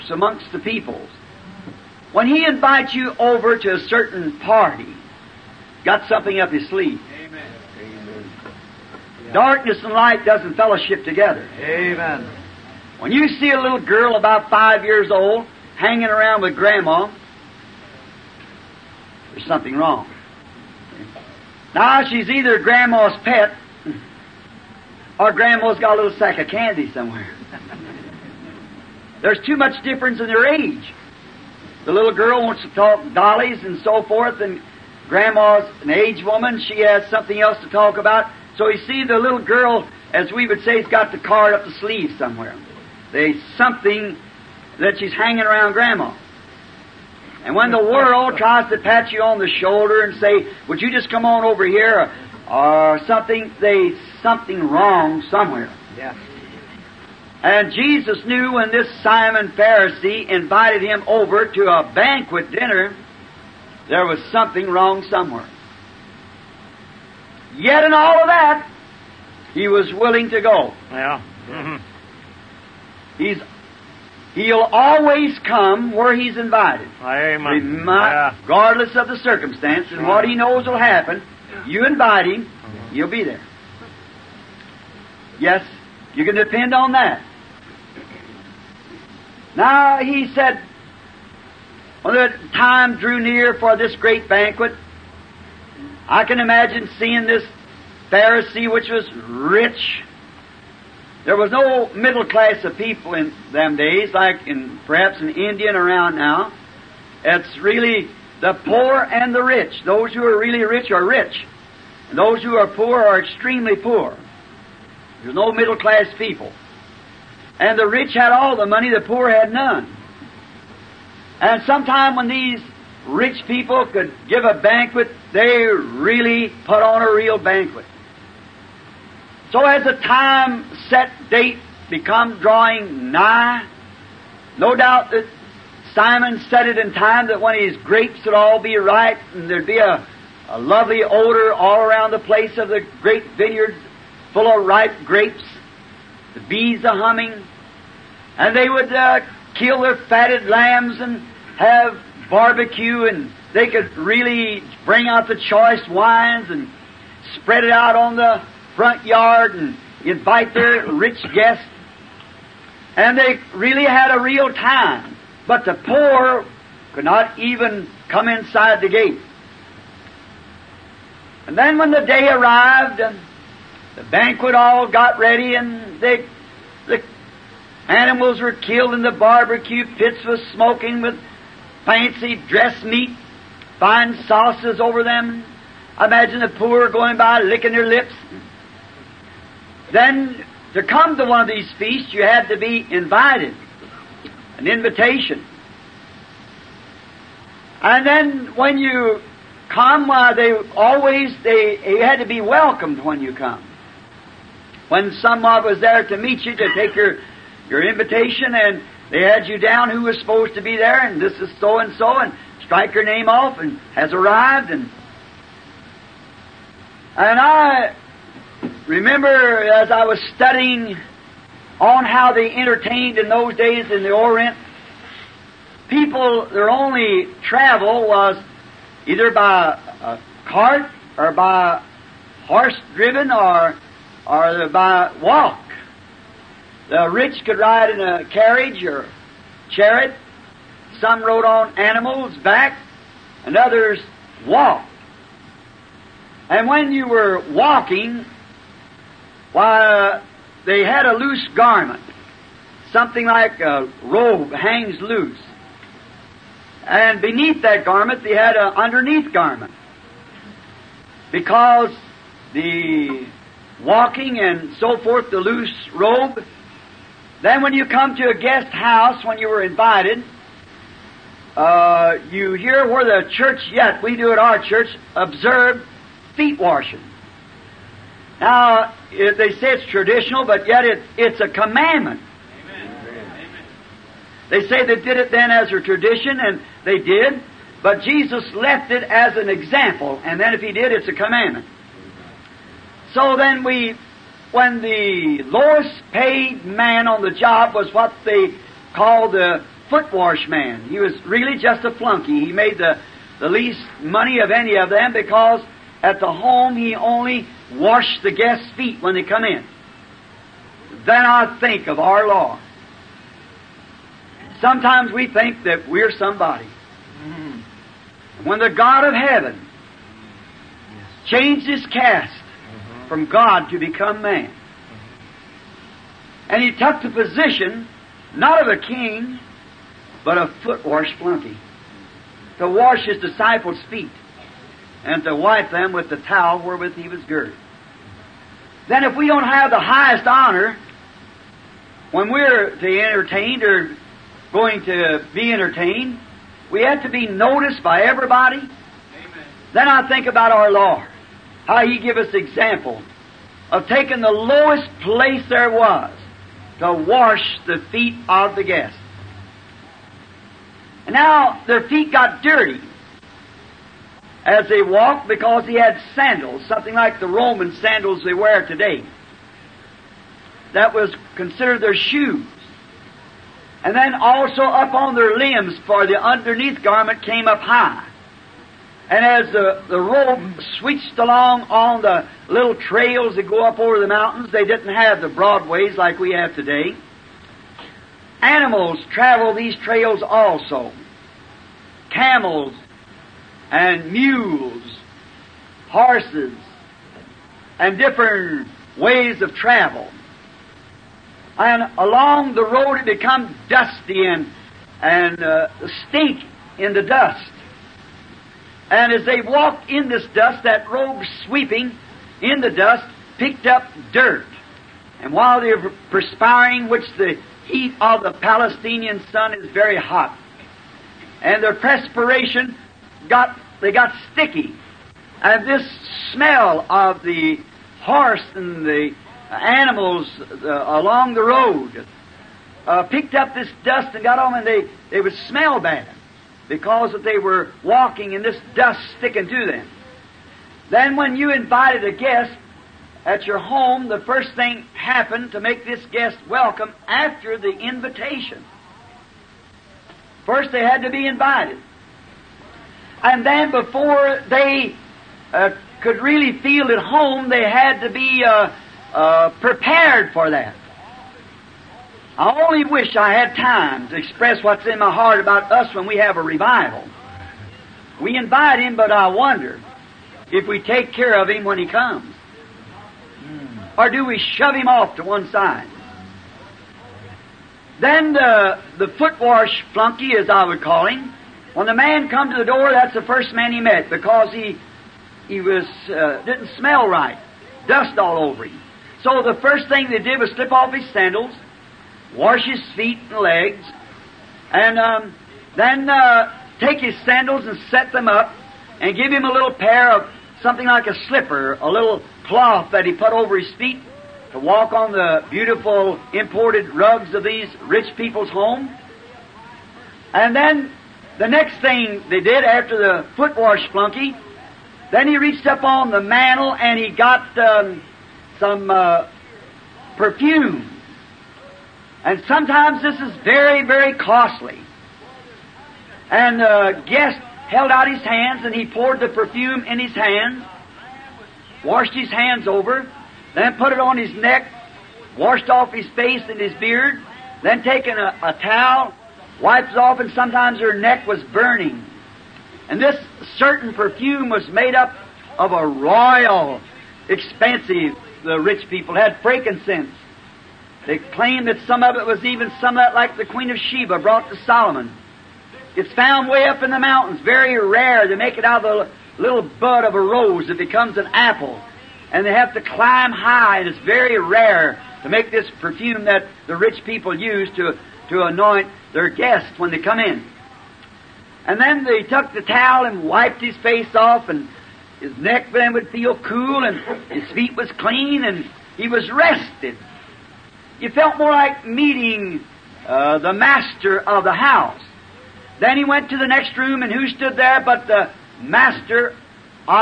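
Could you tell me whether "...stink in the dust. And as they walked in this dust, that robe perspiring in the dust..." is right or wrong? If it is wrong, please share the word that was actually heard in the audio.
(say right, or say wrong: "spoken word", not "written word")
wrong: "sweeping", not "perspiring".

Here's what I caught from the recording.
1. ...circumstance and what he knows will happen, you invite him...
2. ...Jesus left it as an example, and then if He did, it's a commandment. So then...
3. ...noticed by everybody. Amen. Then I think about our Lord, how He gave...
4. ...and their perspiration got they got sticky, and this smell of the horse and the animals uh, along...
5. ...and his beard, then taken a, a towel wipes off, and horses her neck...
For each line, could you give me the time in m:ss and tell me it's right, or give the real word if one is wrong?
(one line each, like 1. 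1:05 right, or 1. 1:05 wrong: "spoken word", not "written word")
1. 1:19 right
2. 4:48 right
3. 5:47 right
4. 7:01 right
5. 8:56 wrong: "sometimes", not "horses".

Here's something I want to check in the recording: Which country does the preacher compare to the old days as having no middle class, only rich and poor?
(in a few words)
India.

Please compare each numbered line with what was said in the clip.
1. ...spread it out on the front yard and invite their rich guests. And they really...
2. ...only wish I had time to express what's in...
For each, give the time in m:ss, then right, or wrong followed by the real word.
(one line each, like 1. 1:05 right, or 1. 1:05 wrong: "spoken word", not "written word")
1. 2:37 right
2. 7:42 right.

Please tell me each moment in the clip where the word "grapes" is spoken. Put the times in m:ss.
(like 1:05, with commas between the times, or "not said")
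2:17, 2:25.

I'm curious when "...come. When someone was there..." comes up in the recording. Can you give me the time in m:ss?
3:23.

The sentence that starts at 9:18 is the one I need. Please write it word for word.
They make it out of a little bud of a rose that becomes an apple.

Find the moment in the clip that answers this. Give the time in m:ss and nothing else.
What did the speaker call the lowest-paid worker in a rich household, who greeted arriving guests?
4:59.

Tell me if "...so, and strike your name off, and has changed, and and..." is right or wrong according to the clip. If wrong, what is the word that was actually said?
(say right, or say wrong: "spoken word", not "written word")
wrong: "arrived", not "changed".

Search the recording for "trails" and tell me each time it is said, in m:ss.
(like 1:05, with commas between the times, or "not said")
6:22, 6:29.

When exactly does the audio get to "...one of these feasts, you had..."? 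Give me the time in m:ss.
3:11.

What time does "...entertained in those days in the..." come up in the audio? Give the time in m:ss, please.
3:42.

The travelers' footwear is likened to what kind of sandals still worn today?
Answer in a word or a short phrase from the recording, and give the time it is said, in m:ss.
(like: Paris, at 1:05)
Roman sandals, at 6:07.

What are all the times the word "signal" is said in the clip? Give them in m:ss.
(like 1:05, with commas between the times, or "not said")
not said.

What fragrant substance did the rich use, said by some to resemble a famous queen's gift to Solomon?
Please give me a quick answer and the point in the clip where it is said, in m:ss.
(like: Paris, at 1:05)
Frankincense, at 9:09.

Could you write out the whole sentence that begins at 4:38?
Now, it, uh, they say it's traditional, but yet it, it's a commandment.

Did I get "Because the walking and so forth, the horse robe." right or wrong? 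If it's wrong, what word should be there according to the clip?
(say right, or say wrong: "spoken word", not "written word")
wrong: "loose", not "horse".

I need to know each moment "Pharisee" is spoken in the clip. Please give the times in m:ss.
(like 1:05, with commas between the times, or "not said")
0:59, 1:38.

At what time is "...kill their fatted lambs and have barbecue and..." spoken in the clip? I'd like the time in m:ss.
2:29.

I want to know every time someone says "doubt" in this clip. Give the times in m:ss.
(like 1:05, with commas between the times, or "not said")
2:14.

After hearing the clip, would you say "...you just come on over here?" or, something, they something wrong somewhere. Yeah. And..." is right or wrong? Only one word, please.
right.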